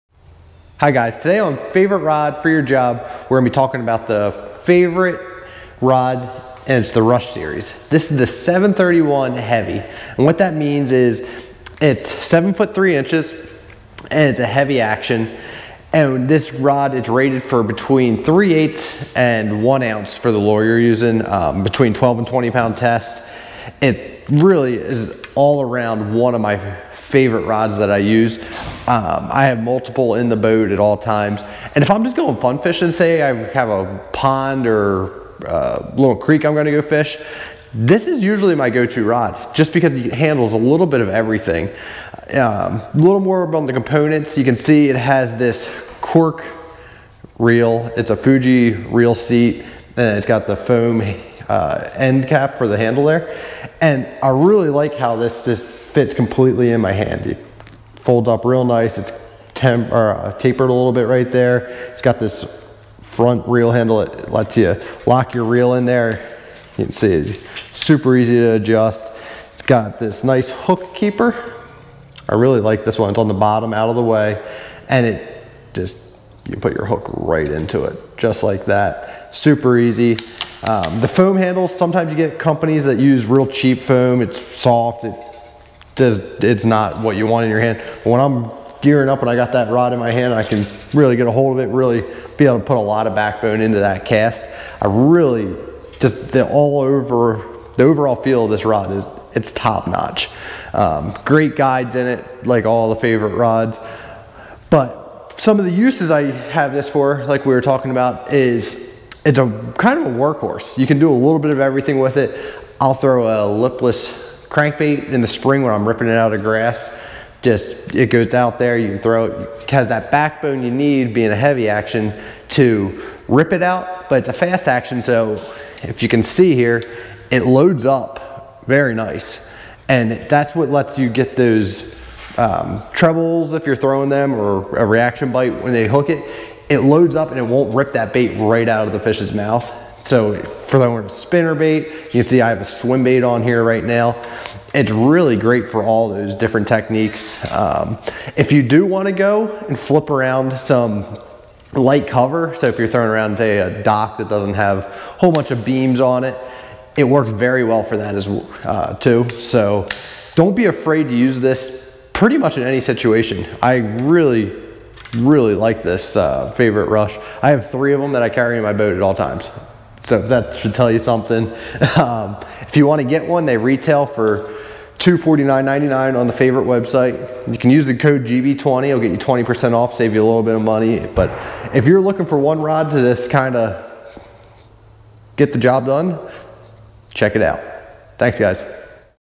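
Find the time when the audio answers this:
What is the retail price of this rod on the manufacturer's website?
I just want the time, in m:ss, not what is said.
2:54.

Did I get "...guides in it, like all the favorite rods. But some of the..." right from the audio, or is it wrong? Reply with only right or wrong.
right.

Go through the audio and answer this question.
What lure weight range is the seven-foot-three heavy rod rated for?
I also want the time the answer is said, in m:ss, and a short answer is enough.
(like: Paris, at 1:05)
3/8 to 1 ounce, at 0:18.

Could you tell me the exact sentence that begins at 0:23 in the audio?
It really is all around one of my favorite rods that I use.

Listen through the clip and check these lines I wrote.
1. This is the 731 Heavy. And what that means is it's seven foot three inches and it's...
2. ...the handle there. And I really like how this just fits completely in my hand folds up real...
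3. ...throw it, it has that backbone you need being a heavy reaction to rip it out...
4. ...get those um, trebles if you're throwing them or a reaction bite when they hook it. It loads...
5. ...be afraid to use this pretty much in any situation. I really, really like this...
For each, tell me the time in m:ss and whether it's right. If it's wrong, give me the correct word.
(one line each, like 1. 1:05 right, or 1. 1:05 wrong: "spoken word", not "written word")
1. 0:07 right
2. 0:52 right
3. 1:58 wrong: "action", not "reaction"
4. 2:11 right
5. 2:40 right.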